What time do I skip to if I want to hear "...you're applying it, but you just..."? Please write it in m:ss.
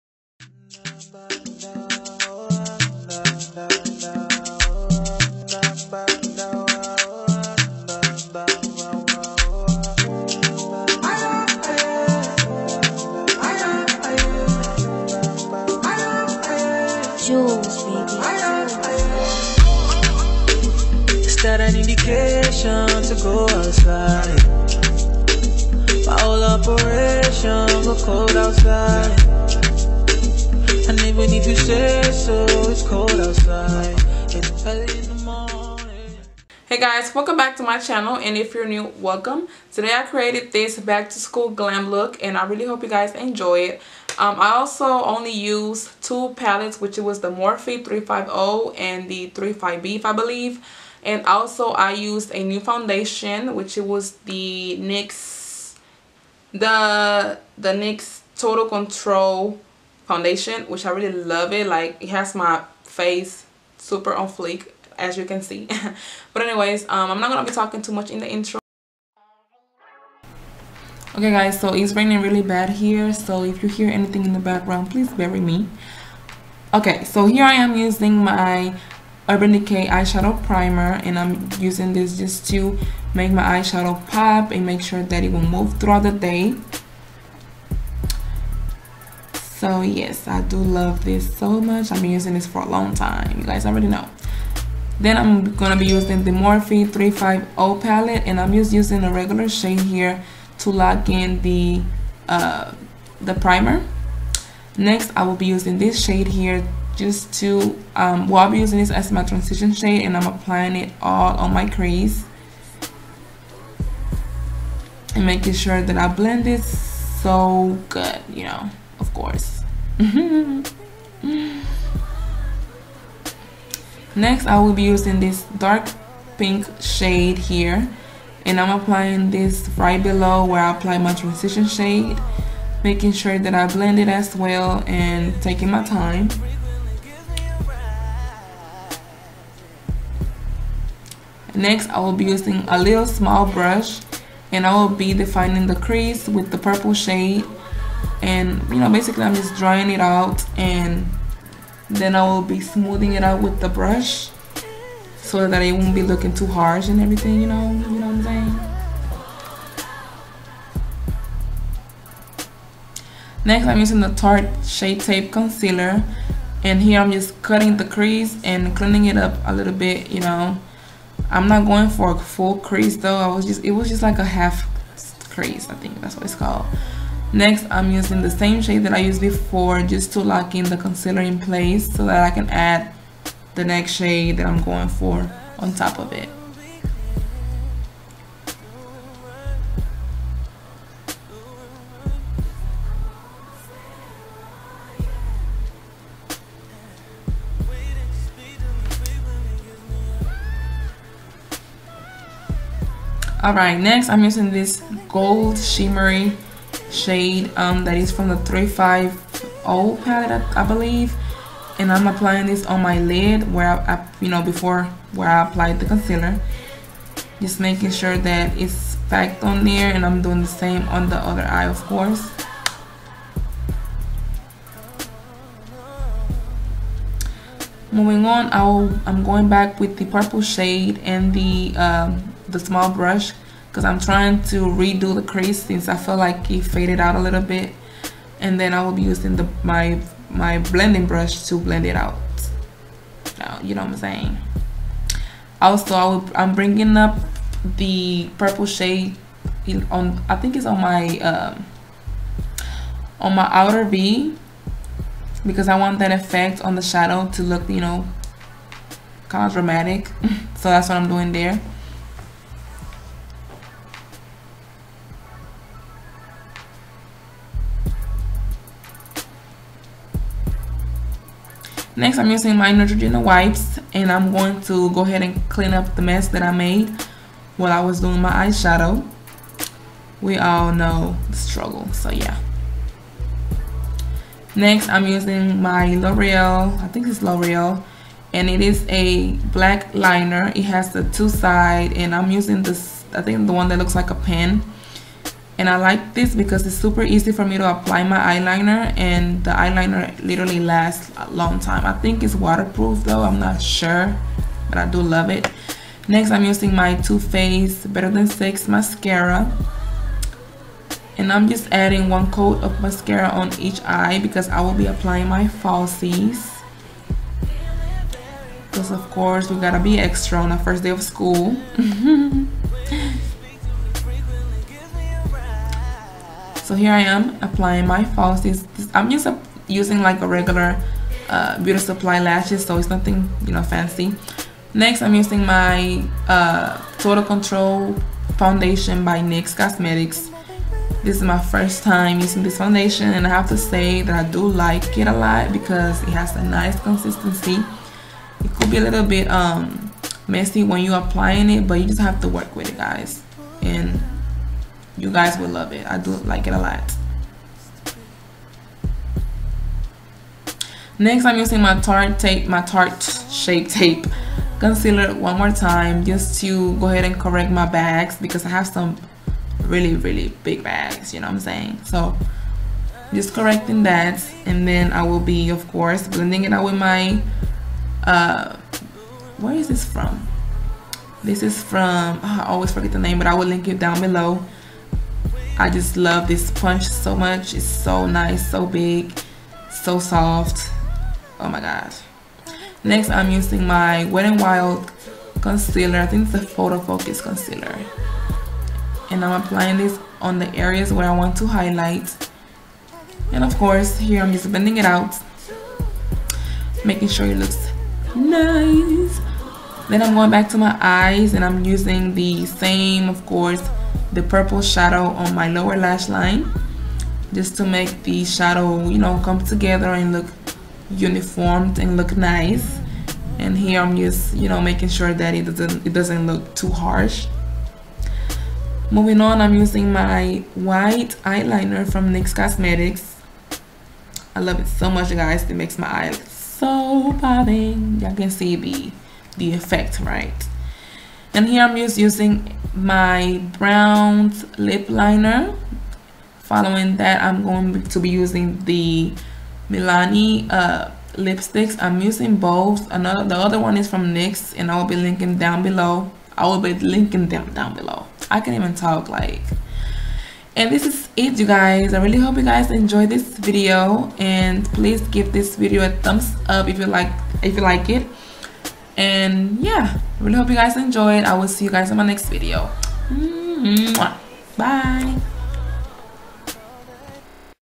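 5:50.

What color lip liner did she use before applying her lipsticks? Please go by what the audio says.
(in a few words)
brown.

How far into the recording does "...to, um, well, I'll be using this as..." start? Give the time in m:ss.
1:47.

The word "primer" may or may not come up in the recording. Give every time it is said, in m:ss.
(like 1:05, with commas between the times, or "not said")
1:20, 1:43.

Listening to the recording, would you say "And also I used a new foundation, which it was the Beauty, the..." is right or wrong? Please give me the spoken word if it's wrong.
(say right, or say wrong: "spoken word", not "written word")
wrong: "NYX", not "Beauty".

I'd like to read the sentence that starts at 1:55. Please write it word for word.
And making sure that I blend it so good, you know, of course.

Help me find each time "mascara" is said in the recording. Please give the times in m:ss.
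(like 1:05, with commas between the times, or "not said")
5:08, 5:12.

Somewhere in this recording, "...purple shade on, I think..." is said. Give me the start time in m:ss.
4:08.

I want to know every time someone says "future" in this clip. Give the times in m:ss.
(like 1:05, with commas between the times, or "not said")
not said.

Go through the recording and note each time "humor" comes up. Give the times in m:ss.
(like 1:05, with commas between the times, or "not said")
not said.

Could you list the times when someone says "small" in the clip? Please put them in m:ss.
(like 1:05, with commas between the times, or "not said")
2:23, 3:52.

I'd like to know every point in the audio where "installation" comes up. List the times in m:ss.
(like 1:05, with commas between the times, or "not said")
not said.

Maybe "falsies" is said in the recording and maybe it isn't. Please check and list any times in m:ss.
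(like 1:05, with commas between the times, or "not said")
5:15, 5:28.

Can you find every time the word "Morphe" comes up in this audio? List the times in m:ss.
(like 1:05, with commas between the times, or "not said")
0:47, 1:36.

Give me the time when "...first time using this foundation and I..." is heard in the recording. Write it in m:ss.
5:41.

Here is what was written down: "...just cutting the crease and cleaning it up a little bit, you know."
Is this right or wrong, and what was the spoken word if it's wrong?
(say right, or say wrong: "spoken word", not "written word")
right.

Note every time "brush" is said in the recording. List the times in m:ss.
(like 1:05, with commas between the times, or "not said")
2:23, 2:33, 3:52, 4:01.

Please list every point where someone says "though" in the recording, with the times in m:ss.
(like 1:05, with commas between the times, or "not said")
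2:52, 5:03.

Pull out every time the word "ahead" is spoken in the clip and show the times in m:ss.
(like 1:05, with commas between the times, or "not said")
4:35, 6:06.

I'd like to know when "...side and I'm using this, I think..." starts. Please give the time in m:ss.
4:51.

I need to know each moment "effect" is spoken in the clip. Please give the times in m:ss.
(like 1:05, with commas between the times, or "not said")
4:16, 7:19.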